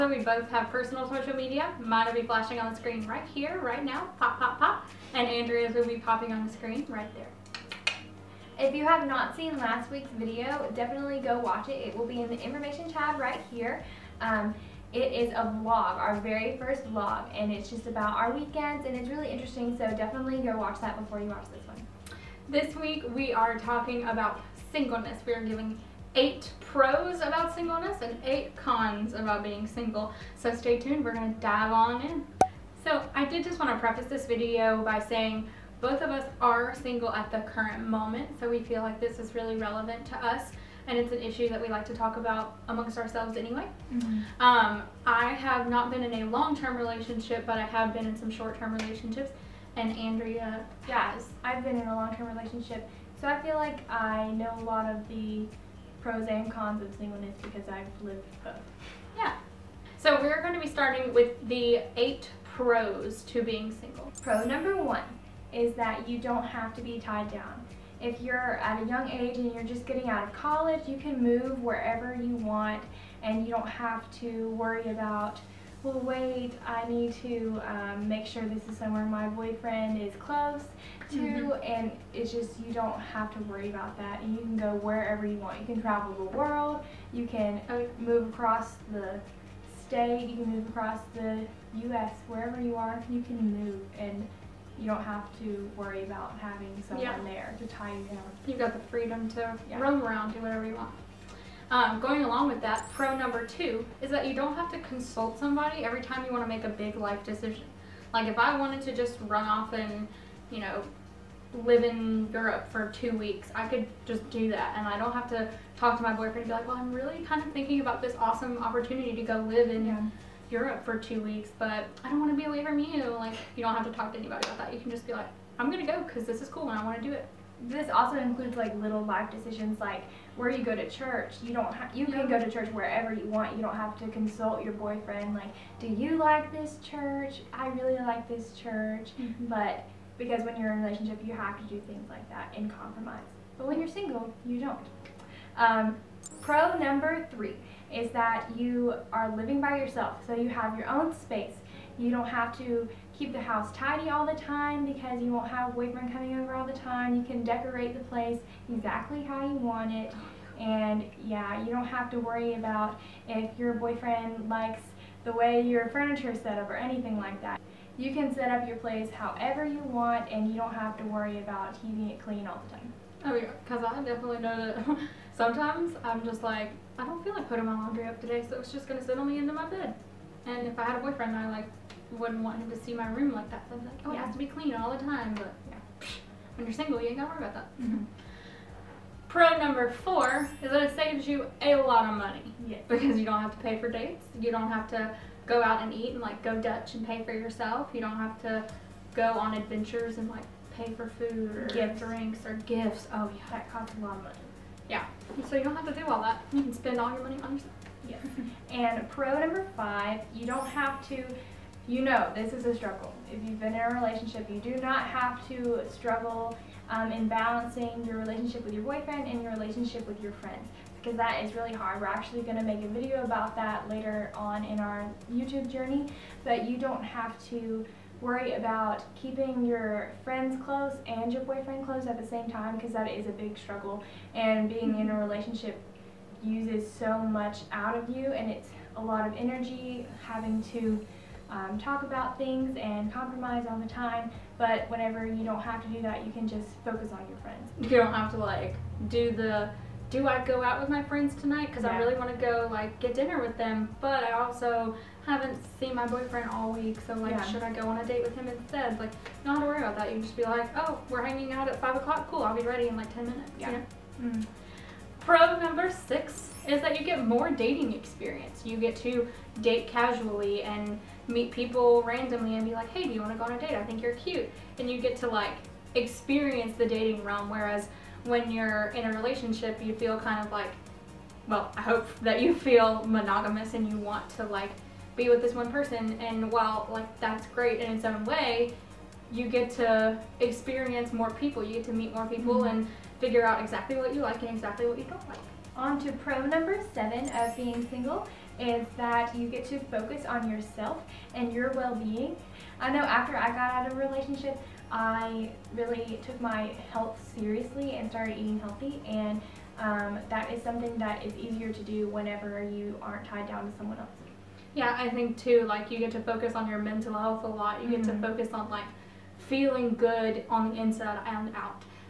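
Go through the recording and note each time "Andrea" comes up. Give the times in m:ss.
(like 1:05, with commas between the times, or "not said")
0:05, 0:49.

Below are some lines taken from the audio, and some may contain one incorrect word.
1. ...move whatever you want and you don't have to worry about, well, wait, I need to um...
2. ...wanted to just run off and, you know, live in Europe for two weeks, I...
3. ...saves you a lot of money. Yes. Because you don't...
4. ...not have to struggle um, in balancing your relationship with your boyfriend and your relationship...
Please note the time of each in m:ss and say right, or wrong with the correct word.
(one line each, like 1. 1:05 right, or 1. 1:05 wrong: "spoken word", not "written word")
1. 1:11 wrong: "wherever", not "whatever"
2. 1:48 right
3. 3:11 right
4. 3:34 right.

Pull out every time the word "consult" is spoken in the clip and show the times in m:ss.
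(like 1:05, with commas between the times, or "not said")
1:44, 2:14.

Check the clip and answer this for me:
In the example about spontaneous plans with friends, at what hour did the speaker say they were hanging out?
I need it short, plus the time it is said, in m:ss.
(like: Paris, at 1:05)
5 o'clock, at 4:21.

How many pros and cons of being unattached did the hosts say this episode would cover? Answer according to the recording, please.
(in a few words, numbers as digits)
8.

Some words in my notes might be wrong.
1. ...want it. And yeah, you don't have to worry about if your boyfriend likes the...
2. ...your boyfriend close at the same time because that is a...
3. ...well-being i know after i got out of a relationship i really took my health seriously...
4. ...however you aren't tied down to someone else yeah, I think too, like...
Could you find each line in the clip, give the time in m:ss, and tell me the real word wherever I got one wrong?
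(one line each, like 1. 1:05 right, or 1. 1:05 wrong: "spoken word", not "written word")
1. 2:39 right
2. 3:51 right
3. 5:01 right
4. 5:12 wrong: "whenever", not "however".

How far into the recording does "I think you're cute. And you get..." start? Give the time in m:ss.
4:33.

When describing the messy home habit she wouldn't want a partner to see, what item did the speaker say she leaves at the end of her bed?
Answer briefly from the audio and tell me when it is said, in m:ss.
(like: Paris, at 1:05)
Laundry, at 2:57.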